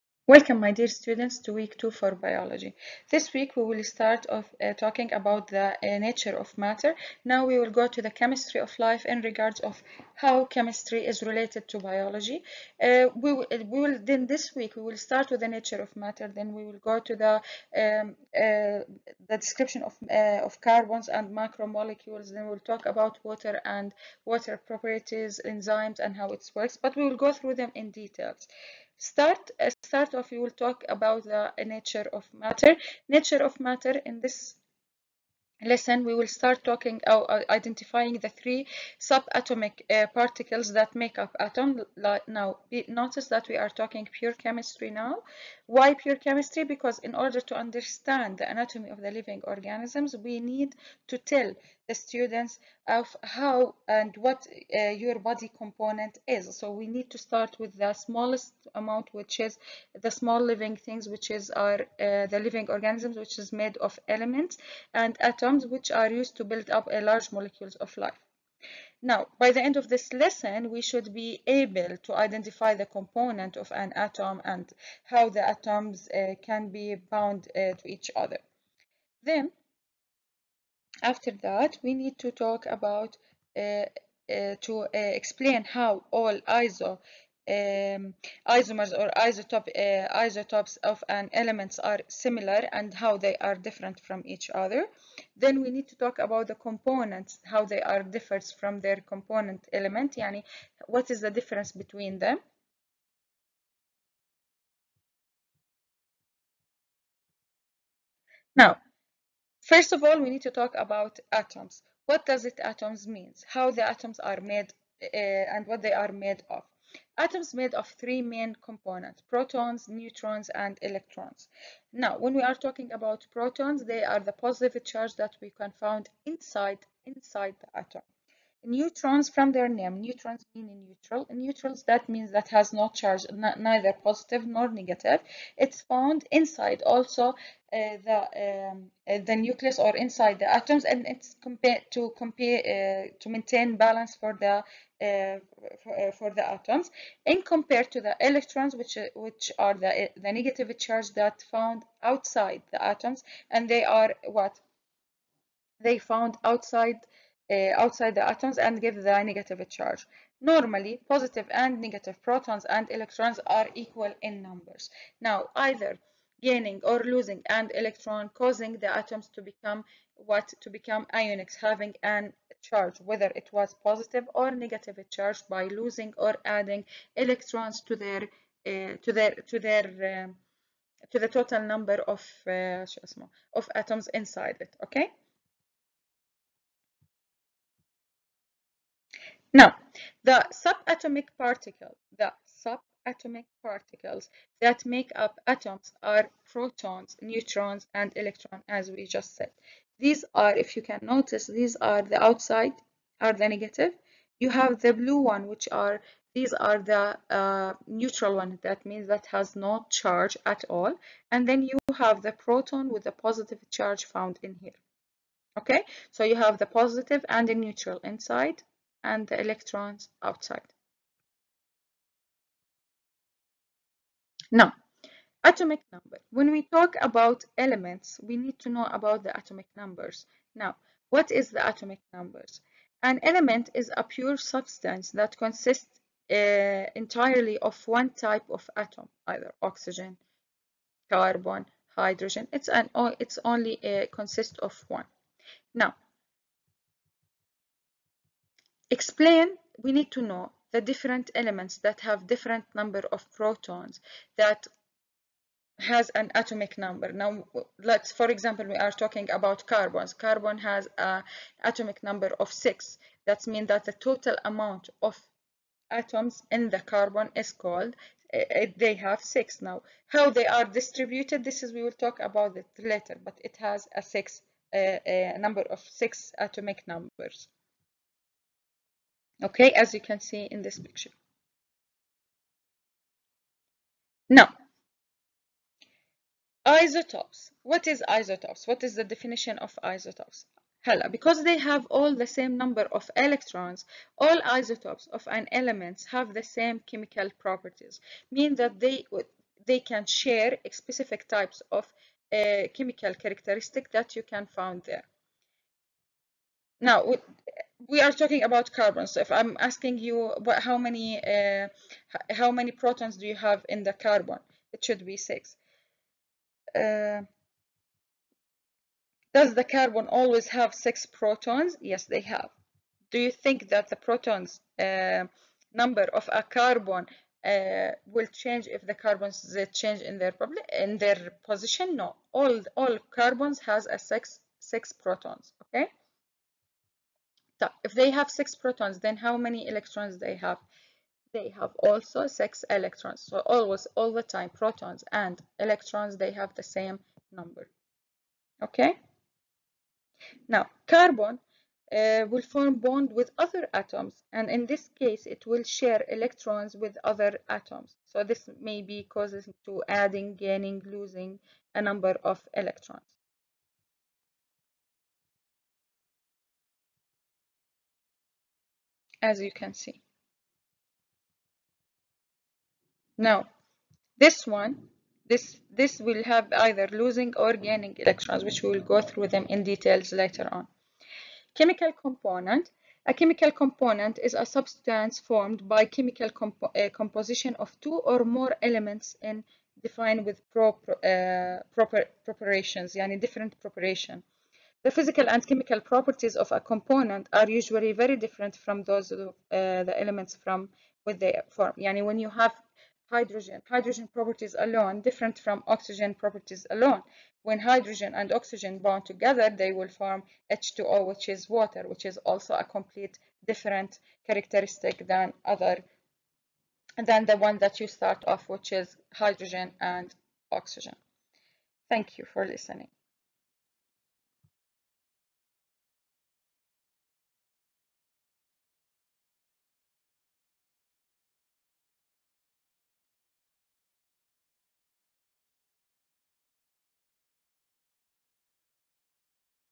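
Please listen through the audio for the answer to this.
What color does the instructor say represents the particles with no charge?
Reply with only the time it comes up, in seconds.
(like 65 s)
204 s.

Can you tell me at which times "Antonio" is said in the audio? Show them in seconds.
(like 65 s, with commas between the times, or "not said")
not said.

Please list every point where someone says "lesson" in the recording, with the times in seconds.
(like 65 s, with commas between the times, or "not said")
35 s, 70 s.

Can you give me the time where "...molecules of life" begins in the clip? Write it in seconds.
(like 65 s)
67 s.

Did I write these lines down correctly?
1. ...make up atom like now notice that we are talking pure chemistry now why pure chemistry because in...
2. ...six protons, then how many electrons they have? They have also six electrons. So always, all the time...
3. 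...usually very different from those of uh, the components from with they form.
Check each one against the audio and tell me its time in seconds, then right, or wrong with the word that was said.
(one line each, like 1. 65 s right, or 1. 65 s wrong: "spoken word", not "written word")
1. 40 s right
2. 338 s right
3. 397 s wrong: "elements", not "components".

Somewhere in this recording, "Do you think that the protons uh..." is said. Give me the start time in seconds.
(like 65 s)
323 s.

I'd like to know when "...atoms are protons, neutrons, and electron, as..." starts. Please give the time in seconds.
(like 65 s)
195 s.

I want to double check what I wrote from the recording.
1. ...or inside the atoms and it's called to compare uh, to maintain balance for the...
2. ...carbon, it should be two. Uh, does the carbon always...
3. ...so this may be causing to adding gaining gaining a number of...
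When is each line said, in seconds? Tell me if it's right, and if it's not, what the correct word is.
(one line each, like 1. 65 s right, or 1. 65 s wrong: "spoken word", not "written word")
1. 139 s wrong: "compared", not "called"
2. 313 s wrong: "six", not "two"
3. 358 s wrong: "losing", not "gaining".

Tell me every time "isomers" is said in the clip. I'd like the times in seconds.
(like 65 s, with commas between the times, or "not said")
88 s.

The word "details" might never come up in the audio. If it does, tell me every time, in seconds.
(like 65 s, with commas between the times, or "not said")
27 s, 379 s.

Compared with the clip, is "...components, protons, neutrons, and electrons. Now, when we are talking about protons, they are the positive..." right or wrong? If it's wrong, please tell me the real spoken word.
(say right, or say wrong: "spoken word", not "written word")
right.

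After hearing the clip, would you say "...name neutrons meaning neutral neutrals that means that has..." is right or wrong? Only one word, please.
right.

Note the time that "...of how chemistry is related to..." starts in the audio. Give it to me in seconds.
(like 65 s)
9 s.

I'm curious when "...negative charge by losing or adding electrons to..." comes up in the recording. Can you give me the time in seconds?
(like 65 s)
174 s.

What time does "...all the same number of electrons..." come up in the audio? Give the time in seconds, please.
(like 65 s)
291 s.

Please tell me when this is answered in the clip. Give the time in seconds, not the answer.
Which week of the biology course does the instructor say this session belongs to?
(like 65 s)
1 s.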